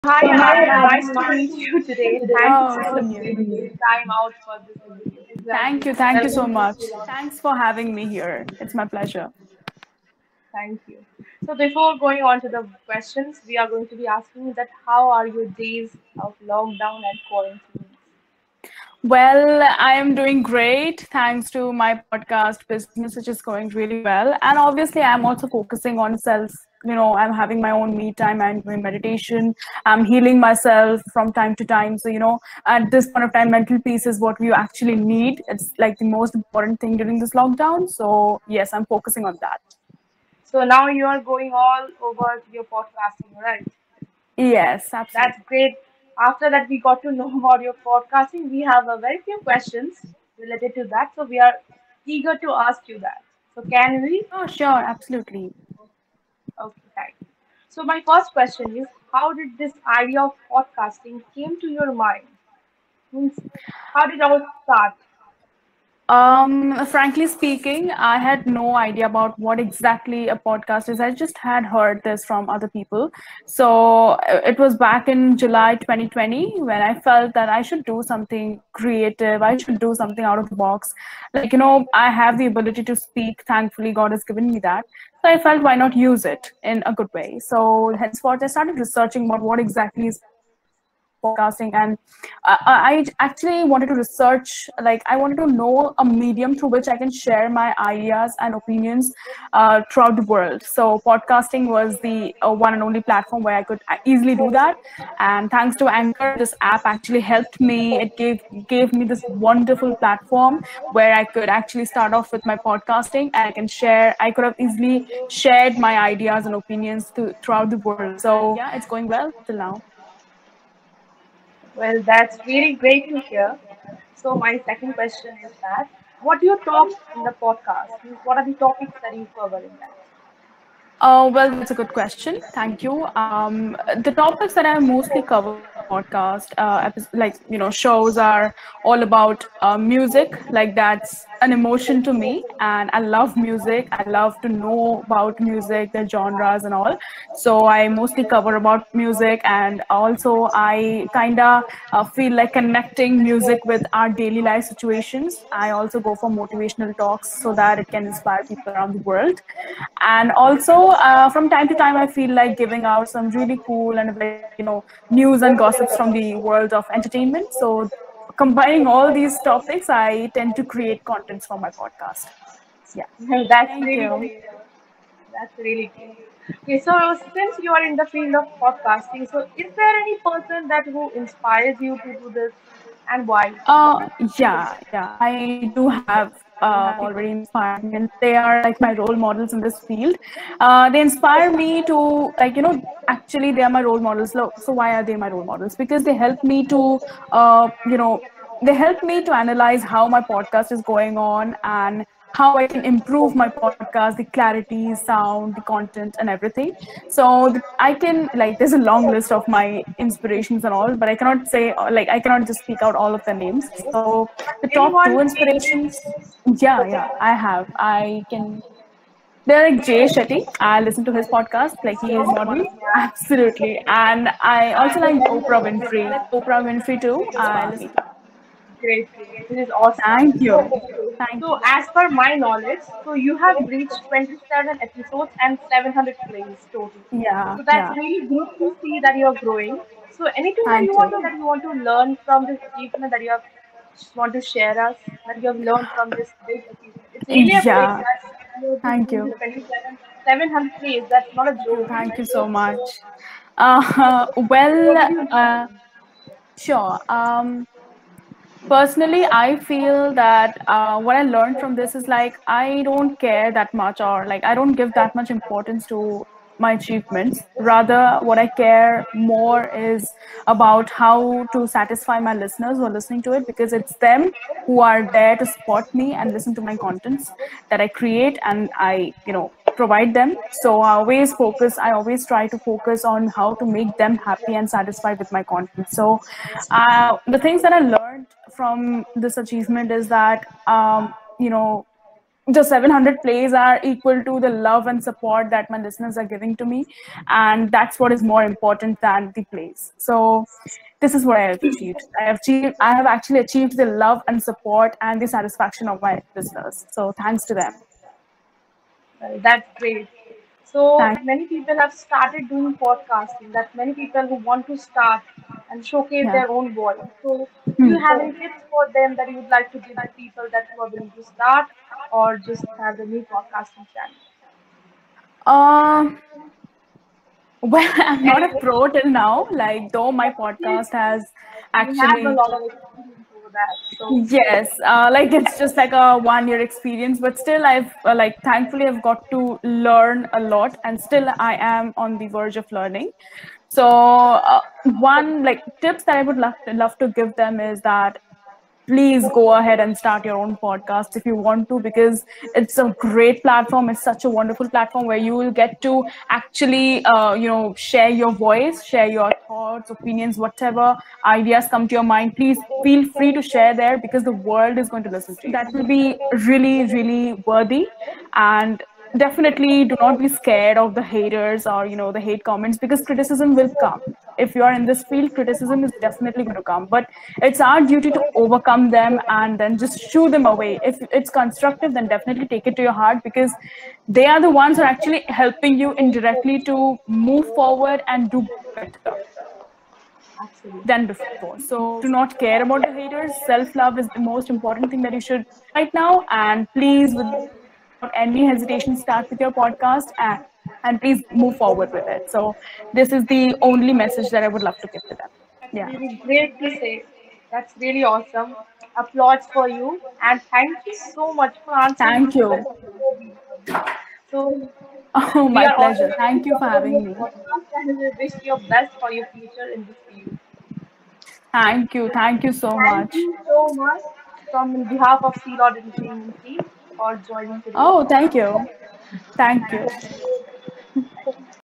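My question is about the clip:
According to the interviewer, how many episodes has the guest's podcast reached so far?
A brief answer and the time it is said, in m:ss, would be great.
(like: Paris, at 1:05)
27, at 3:54.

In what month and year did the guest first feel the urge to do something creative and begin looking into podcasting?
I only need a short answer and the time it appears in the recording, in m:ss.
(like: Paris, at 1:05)
July 2020, at 1:15.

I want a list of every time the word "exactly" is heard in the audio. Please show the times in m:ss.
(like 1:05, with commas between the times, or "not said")
1:09, 1:29.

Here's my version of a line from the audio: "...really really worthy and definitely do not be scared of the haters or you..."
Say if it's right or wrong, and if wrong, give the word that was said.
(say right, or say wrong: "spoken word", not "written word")
right.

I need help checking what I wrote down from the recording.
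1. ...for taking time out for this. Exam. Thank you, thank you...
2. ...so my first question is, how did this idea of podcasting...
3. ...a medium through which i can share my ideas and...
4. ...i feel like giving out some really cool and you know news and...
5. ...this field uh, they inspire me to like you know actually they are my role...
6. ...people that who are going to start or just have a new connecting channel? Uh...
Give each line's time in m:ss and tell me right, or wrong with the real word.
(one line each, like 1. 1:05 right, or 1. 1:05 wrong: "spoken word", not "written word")
1. 0:02 right
2. 0:57 right
3. 1:35 right
4. 2:41 right
5. 3:09 right
6. 5:20 wrong: "podcasting", not "connecting".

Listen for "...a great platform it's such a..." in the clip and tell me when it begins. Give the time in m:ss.
5:52.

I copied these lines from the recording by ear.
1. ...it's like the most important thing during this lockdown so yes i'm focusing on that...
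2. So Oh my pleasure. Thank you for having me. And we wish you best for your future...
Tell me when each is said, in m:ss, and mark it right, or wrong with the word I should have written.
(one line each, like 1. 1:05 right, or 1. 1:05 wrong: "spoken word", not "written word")
1. 0:35 right
2. 6:54 right.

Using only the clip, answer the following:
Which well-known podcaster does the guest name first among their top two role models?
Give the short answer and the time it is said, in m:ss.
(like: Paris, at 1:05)
Jay Shetty, at 3:39.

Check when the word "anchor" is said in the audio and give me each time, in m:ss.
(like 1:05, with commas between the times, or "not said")
1:45.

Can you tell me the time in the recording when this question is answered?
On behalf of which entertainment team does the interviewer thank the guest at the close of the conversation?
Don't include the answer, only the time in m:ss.
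7:05.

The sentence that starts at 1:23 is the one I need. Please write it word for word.
Thankfully, God has given me that.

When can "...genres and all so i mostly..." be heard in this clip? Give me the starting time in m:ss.
2:26.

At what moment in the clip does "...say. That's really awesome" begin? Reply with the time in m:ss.
6:46.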